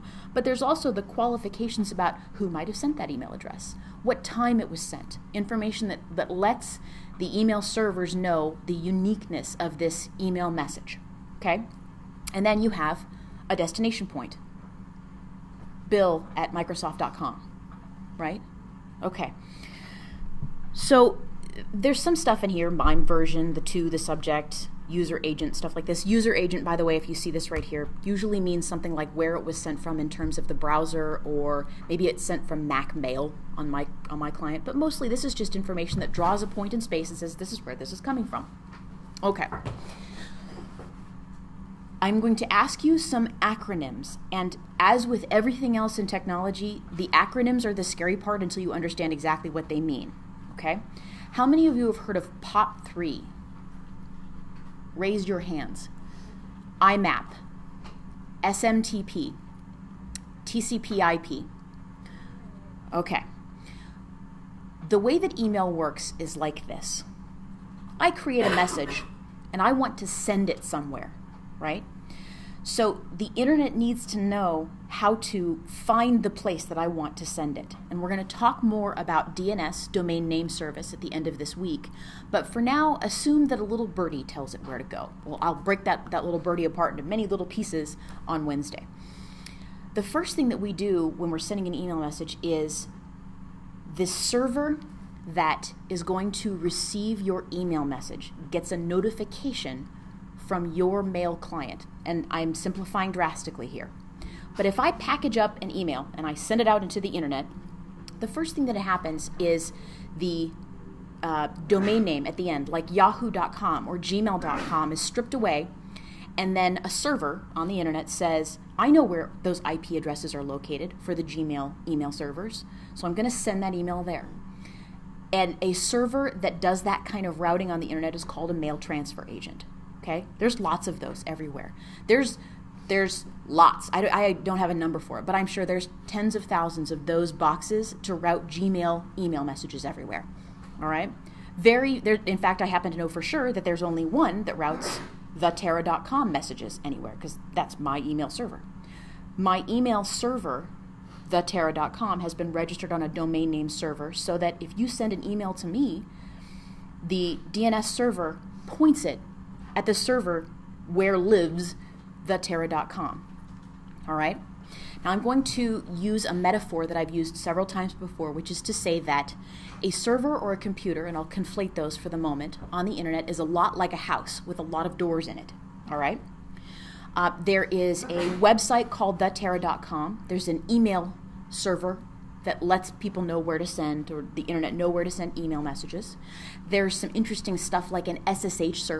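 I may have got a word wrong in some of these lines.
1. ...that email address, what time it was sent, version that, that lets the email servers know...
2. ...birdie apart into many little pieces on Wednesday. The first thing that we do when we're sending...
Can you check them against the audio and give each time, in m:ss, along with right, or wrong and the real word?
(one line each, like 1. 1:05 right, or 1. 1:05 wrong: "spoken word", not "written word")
1. 0:02 wrong: "information", not "version"
2. 1:26 right.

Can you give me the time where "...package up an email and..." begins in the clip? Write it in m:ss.
1:44.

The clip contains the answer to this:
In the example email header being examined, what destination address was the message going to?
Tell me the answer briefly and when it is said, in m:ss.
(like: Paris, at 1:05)
bill at Microsoft.com, at 0:15.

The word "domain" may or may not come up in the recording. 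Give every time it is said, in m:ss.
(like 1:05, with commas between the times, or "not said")
1:19, 1:51, 2:33.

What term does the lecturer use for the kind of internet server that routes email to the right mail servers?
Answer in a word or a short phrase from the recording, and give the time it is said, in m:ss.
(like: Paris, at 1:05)
mail transfer agent, at 2:08.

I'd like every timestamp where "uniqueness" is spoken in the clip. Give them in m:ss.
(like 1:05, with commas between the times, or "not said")
0:08.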